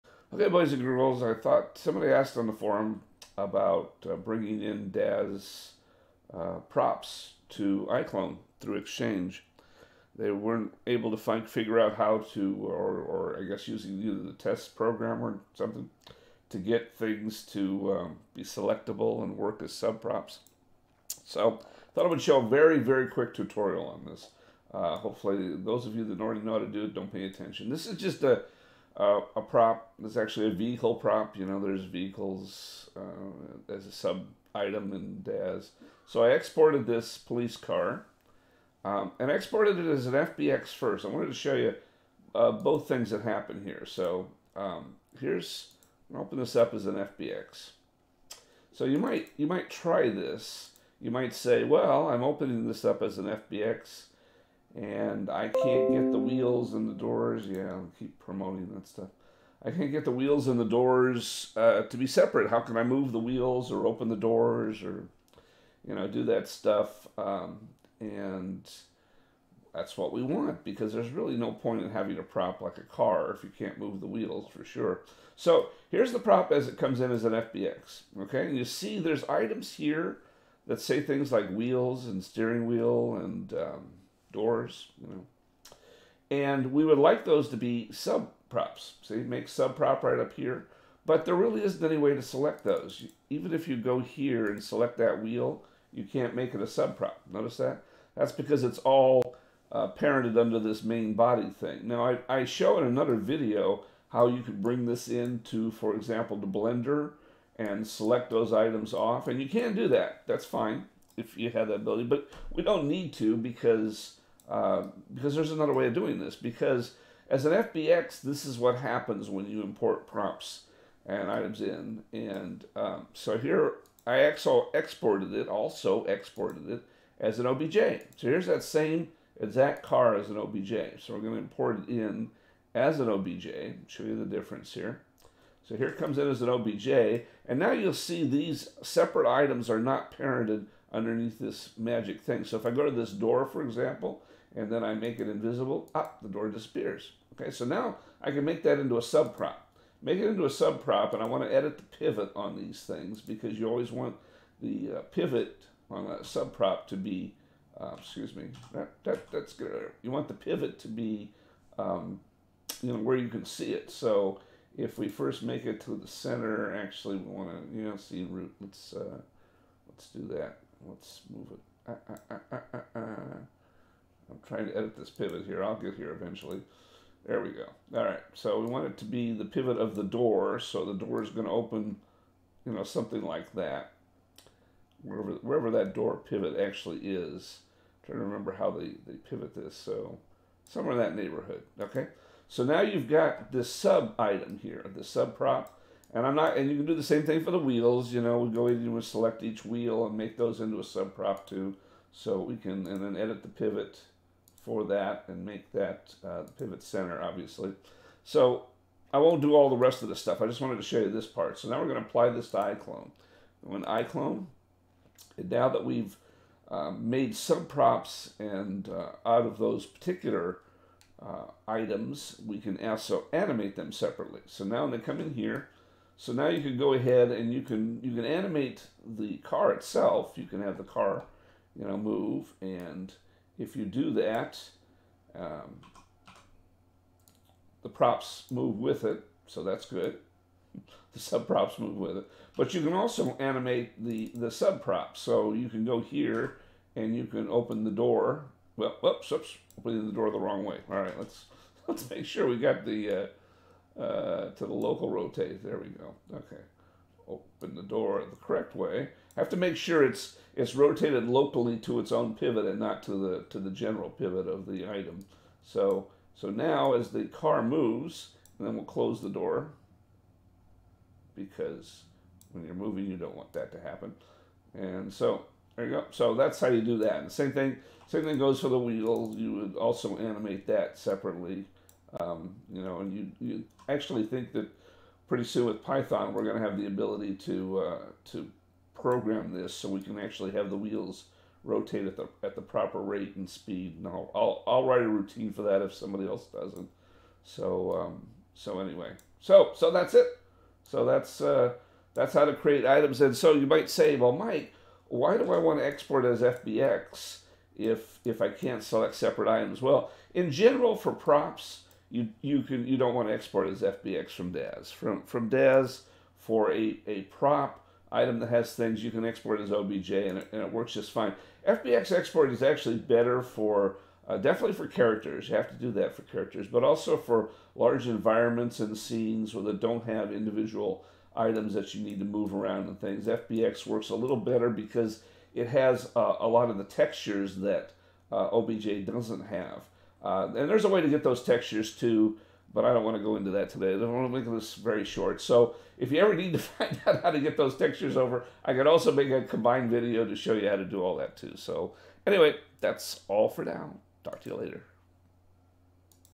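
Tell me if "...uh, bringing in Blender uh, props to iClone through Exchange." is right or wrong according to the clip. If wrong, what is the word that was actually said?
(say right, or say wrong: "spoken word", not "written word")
wrong: "Daz", not "Blender".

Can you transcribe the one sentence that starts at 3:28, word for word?
So I won't do all the rest of the stuff.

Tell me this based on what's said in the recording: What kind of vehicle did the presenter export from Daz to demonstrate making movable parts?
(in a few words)
Police car.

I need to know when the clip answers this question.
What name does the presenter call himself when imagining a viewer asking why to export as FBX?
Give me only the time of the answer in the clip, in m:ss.
5:04.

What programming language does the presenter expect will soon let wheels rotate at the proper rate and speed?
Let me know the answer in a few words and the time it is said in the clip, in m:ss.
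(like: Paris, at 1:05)
Python, at 4:45.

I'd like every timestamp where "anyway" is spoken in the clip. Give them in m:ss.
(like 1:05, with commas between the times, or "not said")
4:58, 5:52.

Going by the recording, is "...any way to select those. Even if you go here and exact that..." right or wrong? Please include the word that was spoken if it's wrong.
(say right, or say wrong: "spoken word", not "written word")
wrong: "select", not "exact".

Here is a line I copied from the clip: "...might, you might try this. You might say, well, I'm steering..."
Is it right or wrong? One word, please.
wrong.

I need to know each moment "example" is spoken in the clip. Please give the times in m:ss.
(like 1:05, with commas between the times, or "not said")
1:45, 2:23.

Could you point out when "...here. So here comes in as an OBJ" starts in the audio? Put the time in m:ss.
2:14.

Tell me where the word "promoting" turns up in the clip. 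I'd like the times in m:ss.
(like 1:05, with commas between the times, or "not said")
0:58.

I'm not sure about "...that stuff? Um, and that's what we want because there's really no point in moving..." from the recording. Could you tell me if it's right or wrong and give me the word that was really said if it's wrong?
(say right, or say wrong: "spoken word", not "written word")
wrong: "having", not "moving".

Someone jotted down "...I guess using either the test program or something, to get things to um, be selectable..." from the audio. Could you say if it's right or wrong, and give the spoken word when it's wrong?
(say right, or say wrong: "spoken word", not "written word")
right.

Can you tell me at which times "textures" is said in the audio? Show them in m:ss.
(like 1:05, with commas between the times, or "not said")
5:36, 5:41, 5:47.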